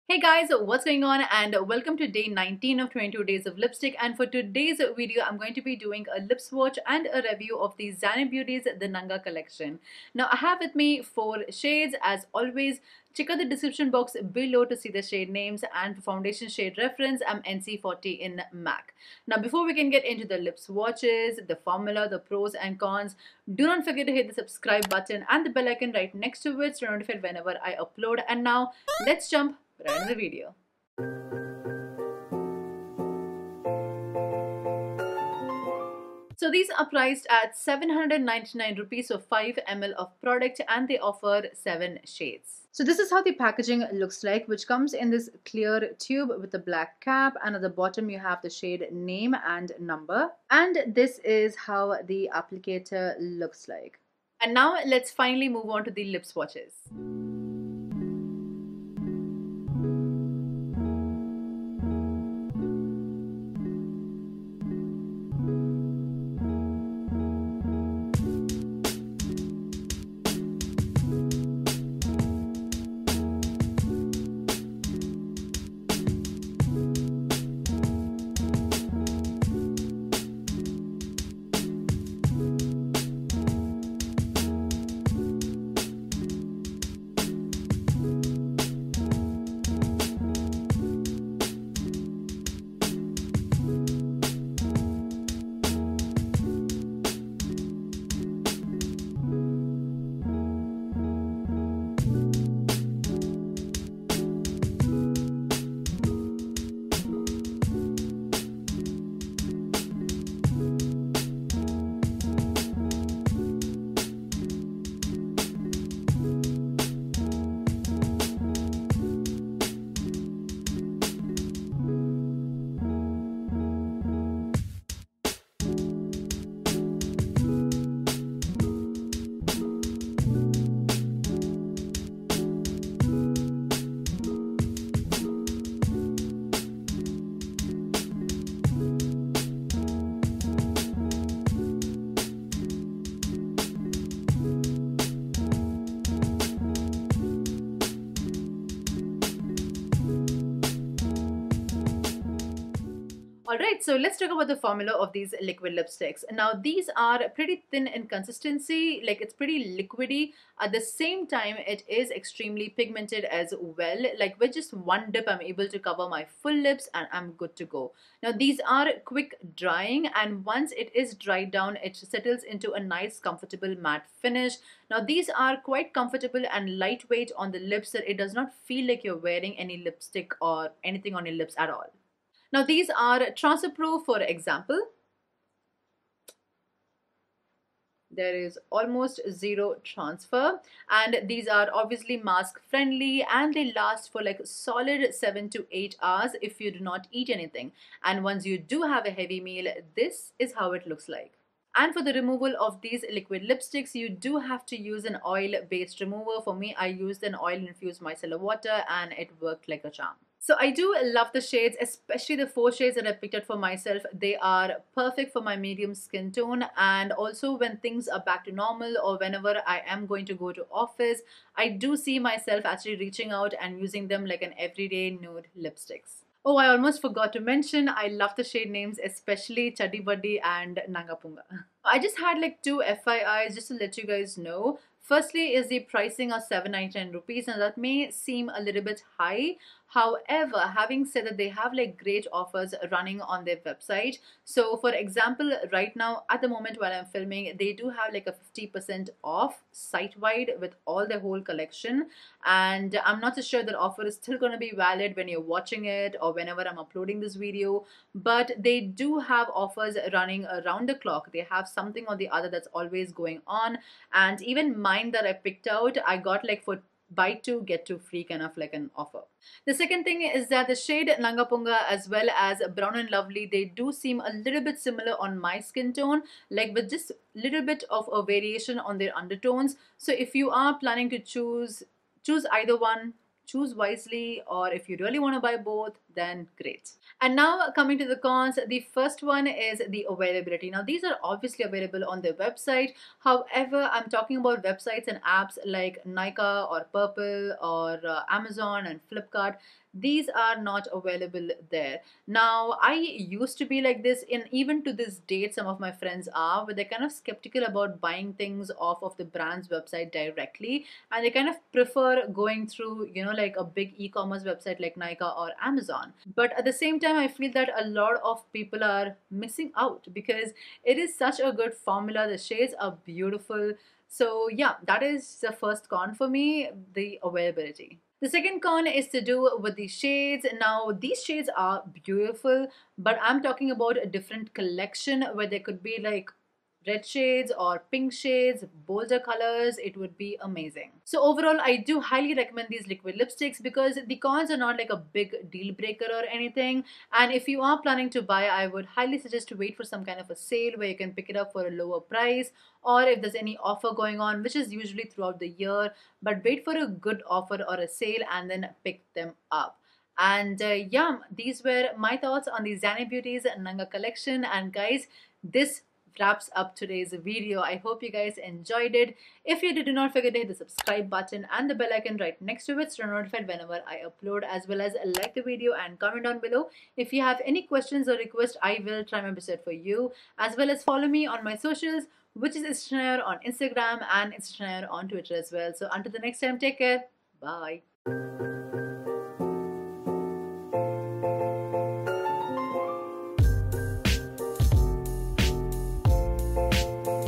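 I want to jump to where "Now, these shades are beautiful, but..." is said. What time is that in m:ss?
5:30.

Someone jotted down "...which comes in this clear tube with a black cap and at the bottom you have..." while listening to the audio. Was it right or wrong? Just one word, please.
right.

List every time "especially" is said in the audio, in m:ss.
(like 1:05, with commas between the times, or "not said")
3:31, 3:49.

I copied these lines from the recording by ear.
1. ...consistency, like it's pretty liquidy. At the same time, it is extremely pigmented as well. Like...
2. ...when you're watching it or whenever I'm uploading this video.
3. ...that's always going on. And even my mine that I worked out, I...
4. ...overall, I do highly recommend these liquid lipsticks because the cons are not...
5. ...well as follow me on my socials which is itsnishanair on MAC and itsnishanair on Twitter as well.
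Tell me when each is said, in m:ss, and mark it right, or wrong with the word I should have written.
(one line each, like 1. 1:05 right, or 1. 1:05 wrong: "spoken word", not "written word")
1. 2:38 right
2. 4:15 right
3. 4:22 wrong: "picked", not "worked"
4. 5:41 right
5. 6:20 wrong: "Instagram", not "MAC".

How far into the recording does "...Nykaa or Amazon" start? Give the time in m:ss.
5:14.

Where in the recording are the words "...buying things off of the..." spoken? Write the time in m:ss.
5:08.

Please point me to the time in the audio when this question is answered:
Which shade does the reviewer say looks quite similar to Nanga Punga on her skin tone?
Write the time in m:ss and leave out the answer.
4:32.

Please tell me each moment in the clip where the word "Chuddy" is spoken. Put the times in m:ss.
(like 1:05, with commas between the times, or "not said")
3:49.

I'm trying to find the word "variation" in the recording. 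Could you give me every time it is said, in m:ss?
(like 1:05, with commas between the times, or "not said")
4:38.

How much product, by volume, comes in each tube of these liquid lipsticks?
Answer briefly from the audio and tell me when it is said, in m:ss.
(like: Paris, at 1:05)
5 ml, at 0:39.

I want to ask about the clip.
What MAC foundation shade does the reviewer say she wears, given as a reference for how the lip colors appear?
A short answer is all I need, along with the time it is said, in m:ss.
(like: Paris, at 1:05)
NC40, at 0:17.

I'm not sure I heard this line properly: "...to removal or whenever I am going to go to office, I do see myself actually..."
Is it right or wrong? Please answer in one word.
wrong.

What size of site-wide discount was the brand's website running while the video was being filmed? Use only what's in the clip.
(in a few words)
50%.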